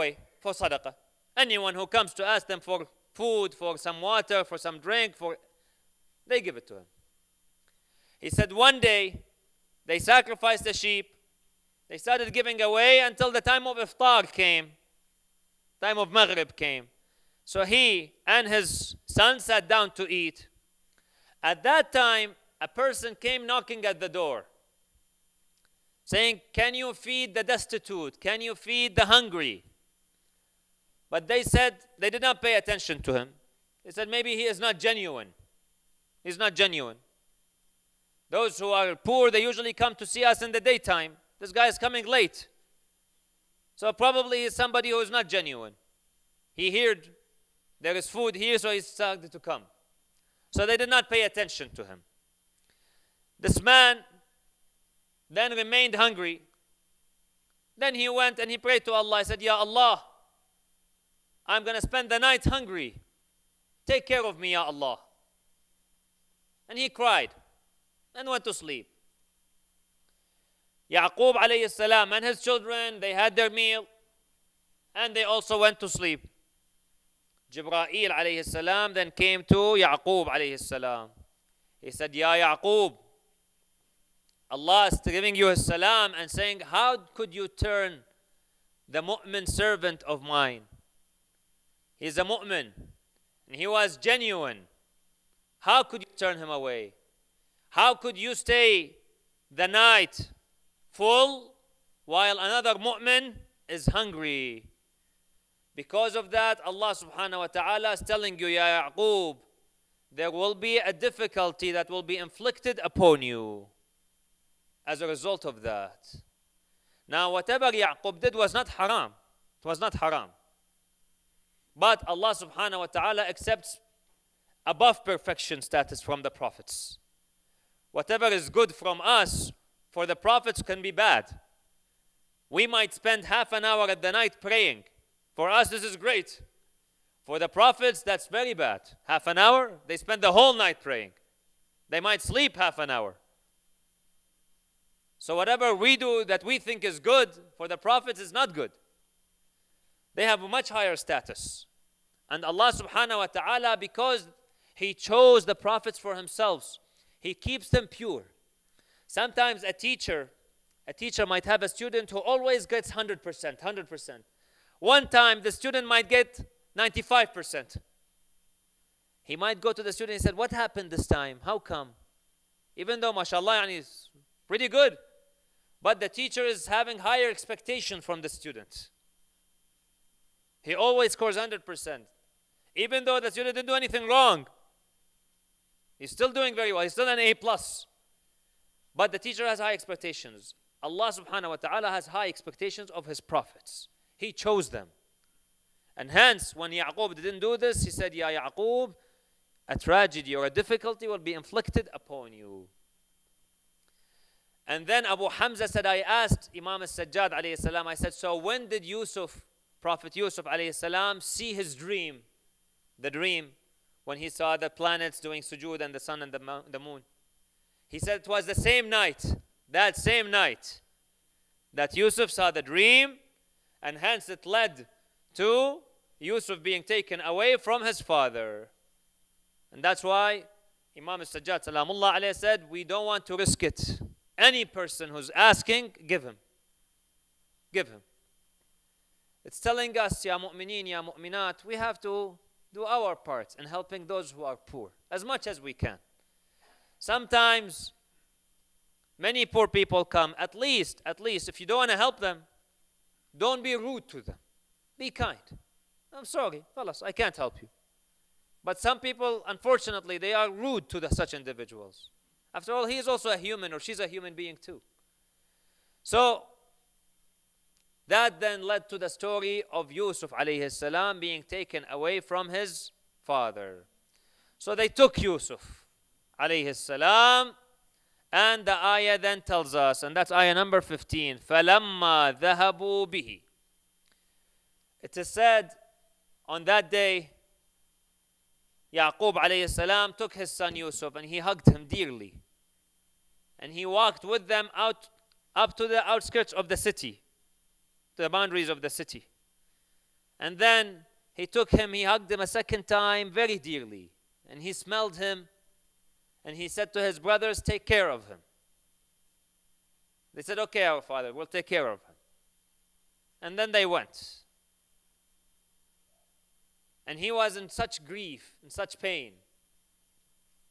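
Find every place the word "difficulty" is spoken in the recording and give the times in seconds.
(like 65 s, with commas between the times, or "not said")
110 s, 200 s.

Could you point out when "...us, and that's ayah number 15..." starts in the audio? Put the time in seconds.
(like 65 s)
279 s.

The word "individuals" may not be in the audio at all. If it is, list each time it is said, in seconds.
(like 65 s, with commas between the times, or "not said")
261 s.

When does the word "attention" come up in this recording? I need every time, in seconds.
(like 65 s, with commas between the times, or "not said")
32 s, 51 s.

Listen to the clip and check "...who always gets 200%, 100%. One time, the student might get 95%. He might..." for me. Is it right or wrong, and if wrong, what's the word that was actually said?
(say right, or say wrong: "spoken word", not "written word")
wrong: "100", not "200".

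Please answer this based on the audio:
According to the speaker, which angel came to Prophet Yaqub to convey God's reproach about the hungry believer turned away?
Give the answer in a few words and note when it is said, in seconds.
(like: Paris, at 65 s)
Jibra'il, at 77 s.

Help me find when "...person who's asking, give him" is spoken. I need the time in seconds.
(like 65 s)
234 s.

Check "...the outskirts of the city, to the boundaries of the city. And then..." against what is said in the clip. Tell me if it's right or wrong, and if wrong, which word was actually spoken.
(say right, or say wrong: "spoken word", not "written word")
right.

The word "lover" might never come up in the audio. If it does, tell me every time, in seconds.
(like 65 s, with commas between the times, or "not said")
not said.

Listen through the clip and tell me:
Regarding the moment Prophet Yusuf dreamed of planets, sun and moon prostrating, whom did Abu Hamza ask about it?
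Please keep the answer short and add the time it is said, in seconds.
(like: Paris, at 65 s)
Imam al-Sajjad, at 206 s.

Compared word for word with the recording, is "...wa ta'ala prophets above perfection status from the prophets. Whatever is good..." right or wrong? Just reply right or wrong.
wrong.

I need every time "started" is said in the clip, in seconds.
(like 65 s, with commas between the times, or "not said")
11 s, 48 s.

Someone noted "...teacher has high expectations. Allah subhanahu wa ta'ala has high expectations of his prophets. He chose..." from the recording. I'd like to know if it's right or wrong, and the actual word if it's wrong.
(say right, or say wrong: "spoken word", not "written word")
right.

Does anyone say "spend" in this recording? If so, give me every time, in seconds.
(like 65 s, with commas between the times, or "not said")
61 s, 132 s, 139 s.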